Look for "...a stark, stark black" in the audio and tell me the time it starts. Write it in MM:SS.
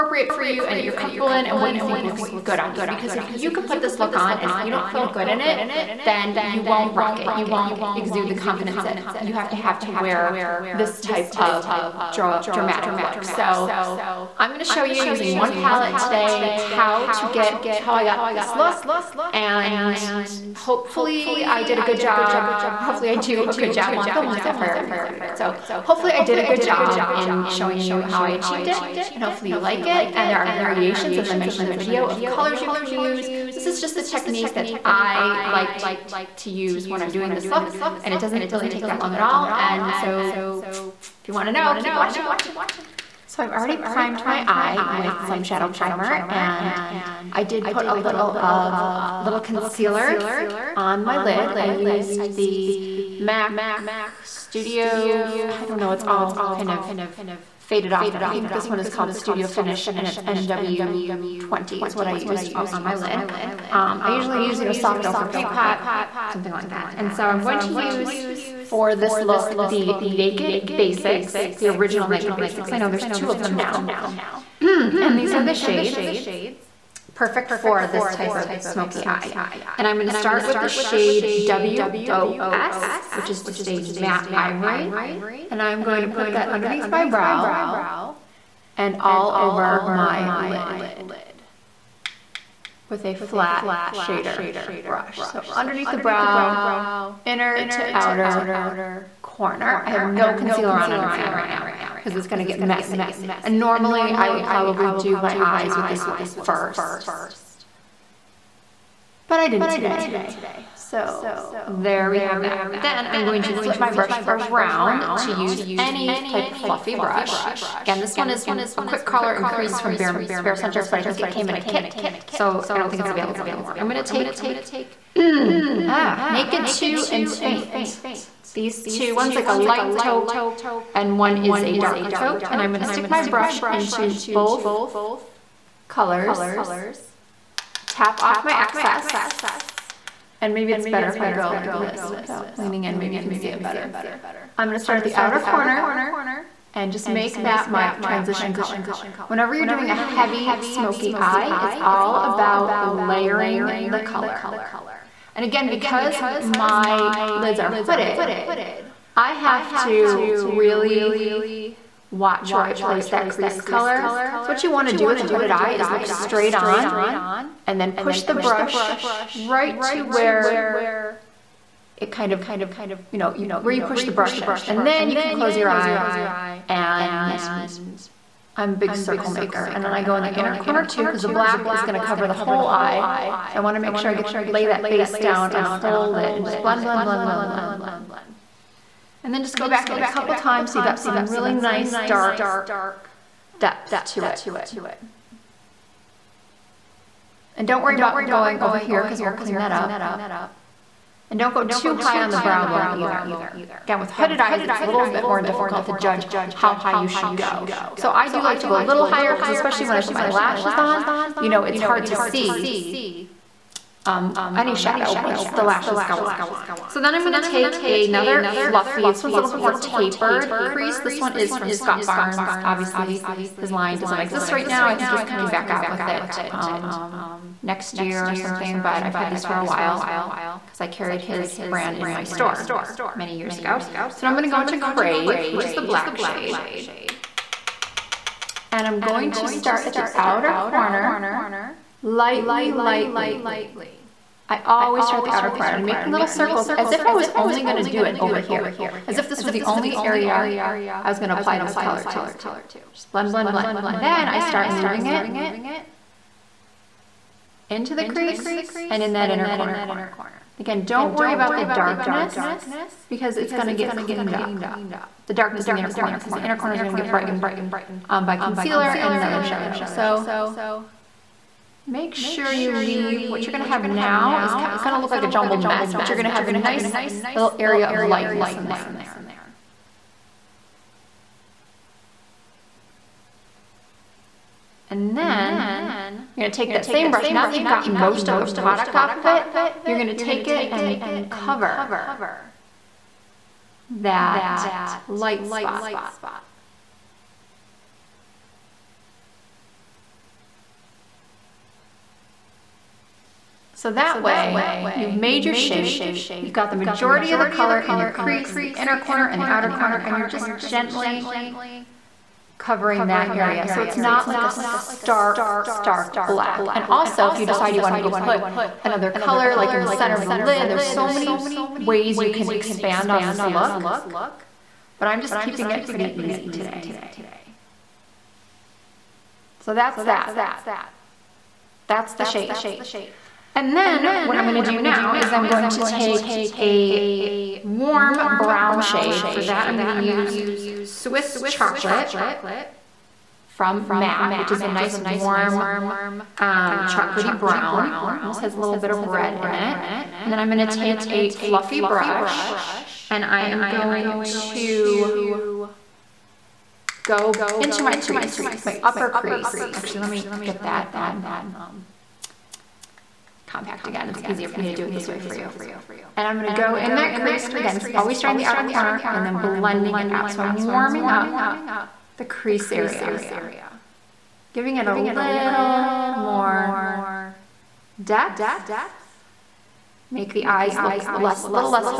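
05:14.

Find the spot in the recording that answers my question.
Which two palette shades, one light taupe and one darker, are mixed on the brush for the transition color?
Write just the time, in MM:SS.
02:06.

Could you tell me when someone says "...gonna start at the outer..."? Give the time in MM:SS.
02:24.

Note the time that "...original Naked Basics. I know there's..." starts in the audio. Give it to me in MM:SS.
01:11.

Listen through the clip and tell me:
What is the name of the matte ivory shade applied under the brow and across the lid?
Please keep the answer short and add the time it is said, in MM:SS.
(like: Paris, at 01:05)
WOS, at 01:21.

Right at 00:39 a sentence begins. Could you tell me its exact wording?
And so if you wanna know, keep watching.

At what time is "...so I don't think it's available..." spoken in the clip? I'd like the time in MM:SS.
02:02.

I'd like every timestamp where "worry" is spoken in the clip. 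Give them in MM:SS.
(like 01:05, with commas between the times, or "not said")
03:17, 04:21.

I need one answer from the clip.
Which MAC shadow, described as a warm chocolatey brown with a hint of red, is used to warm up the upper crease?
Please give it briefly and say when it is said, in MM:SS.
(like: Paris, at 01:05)
Swiss Chocolate, at 05:40.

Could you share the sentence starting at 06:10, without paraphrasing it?
So I'm warming up the crease area giving it a little more depth.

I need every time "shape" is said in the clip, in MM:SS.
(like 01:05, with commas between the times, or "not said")
05:05, 05:32.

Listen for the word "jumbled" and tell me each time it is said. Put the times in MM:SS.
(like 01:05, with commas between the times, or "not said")
04:35.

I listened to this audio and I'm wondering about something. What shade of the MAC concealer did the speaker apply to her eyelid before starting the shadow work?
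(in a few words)
NW20.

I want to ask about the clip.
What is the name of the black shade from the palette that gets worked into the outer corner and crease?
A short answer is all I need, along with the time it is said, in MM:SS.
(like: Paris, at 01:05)
Crave, at 03:54.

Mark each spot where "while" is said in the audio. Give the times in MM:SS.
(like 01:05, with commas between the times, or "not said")
00:23, 03:49.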